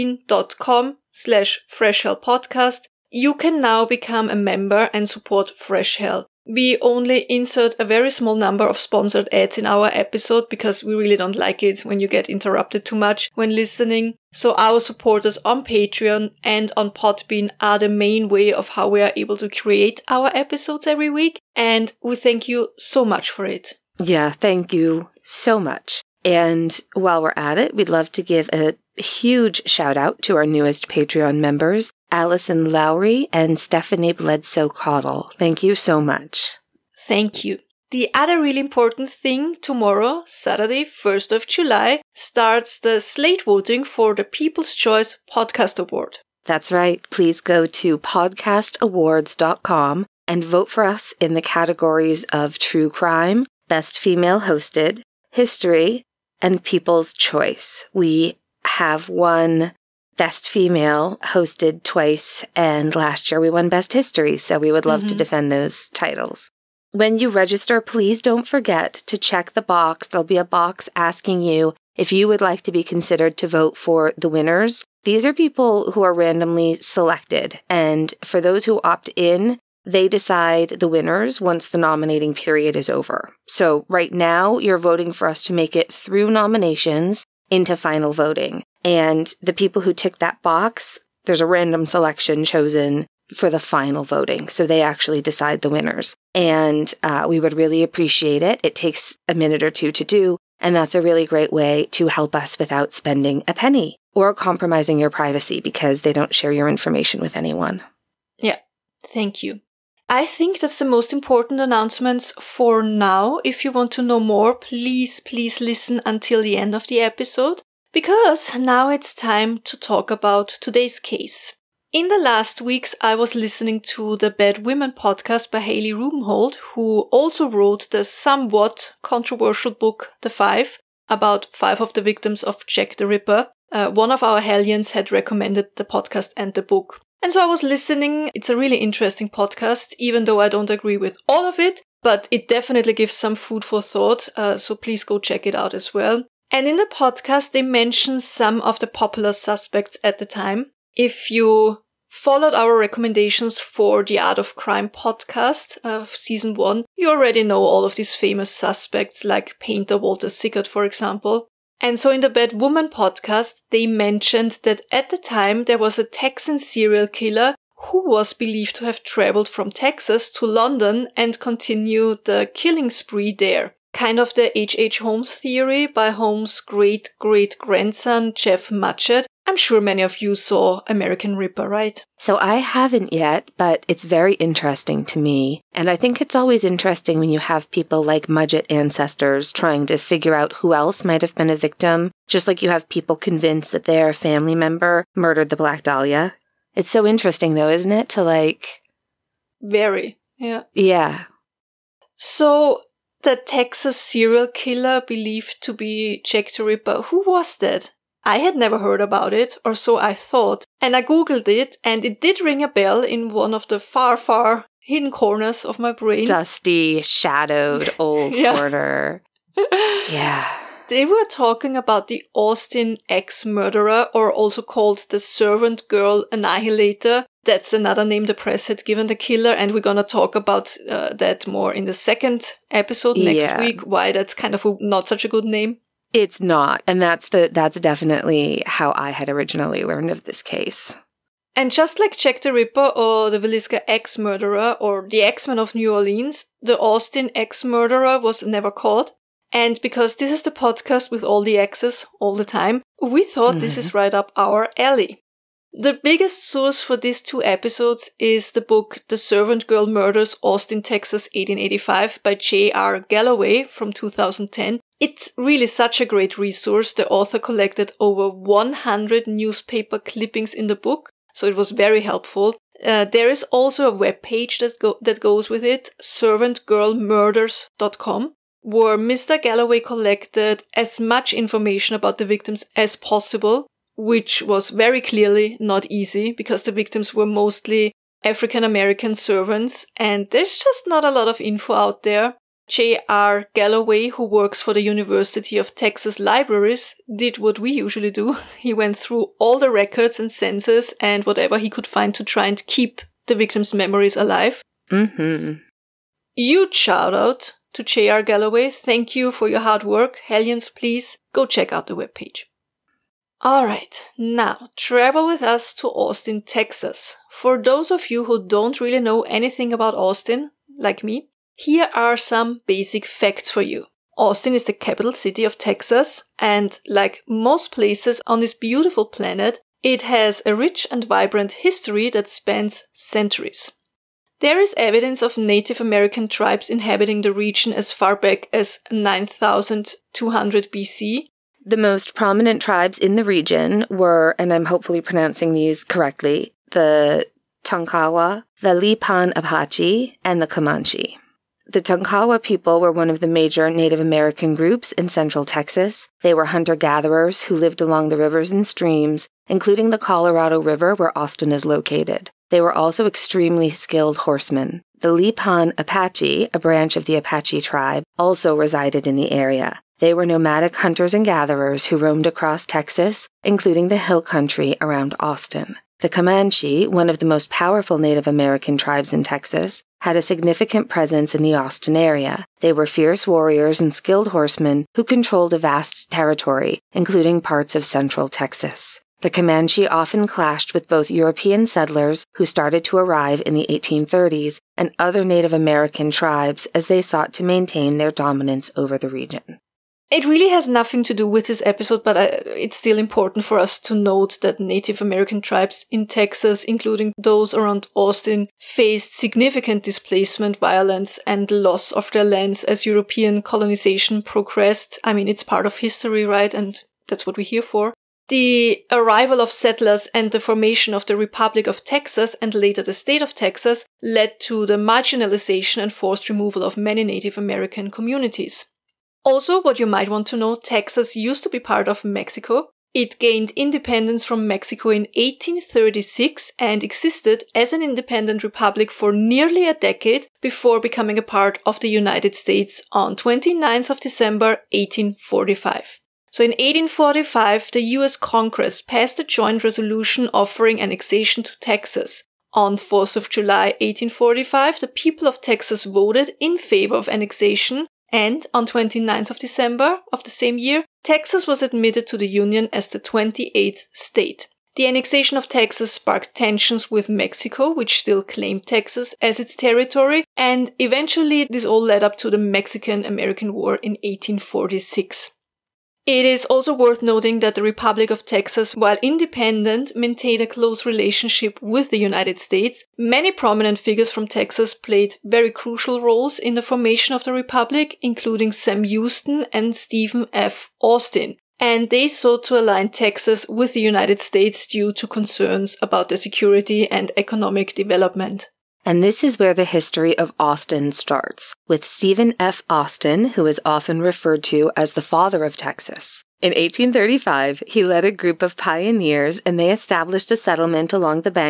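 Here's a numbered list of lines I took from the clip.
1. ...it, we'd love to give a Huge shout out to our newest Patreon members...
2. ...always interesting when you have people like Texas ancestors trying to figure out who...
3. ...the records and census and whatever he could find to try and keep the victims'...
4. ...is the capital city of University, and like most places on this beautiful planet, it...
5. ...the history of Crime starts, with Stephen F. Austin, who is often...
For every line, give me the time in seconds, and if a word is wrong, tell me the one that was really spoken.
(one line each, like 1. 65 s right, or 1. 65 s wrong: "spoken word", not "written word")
1. 27 s right
2. 186 s wrong: "Mudgett", not "Texas"
3. 299 s right
4. 324 s wrong: "Texas", not "University"
5. 499 s wrong: "Austin", not "Crime".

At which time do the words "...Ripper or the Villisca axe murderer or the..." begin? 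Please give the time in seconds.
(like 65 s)
242 s.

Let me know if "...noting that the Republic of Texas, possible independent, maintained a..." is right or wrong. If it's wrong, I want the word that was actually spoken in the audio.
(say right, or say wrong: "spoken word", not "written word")
wrong: "while", not "possible".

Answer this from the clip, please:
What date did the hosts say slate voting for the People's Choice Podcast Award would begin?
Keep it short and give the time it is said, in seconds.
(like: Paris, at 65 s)
Saturday, 1st of July, at 40 s.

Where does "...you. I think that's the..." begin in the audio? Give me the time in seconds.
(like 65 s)
109 s.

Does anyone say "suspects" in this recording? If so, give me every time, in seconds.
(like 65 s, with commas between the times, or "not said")
149 s, 158 s.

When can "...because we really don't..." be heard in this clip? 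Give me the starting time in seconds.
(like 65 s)
10 s.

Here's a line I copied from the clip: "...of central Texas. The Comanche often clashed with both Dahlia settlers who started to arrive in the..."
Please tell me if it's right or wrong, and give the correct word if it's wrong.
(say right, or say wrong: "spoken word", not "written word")
wrong: "European", not "Dahlia".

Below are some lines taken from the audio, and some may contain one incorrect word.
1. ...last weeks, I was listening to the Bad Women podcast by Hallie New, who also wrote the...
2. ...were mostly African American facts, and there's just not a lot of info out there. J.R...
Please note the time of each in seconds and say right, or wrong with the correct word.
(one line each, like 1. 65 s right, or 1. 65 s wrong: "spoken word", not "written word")
1. 122 s wrong: "Rubenhold", not "New"
2. 287 s wrong: "servants", not "facts".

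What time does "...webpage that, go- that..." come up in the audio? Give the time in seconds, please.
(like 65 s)
273 s.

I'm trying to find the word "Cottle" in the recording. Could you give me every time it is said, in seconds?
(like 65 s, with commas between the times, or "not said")
34 s.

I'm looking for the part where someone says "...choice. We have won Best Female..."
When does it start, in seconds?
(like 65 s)
57 s.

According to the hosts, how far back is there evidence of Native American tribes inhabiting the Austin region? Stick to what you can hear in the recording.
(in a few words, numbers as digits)
9200 BC.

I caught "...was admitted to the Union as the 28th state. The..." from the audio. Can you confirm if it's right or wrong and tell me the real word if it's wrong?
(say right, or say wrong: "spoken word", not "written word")
right.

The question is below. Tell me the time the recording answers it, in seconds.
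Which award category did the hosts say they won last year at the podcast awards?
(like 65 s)
63 s.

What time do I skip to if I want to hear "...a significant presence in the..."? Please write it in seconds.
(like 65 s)
380 s.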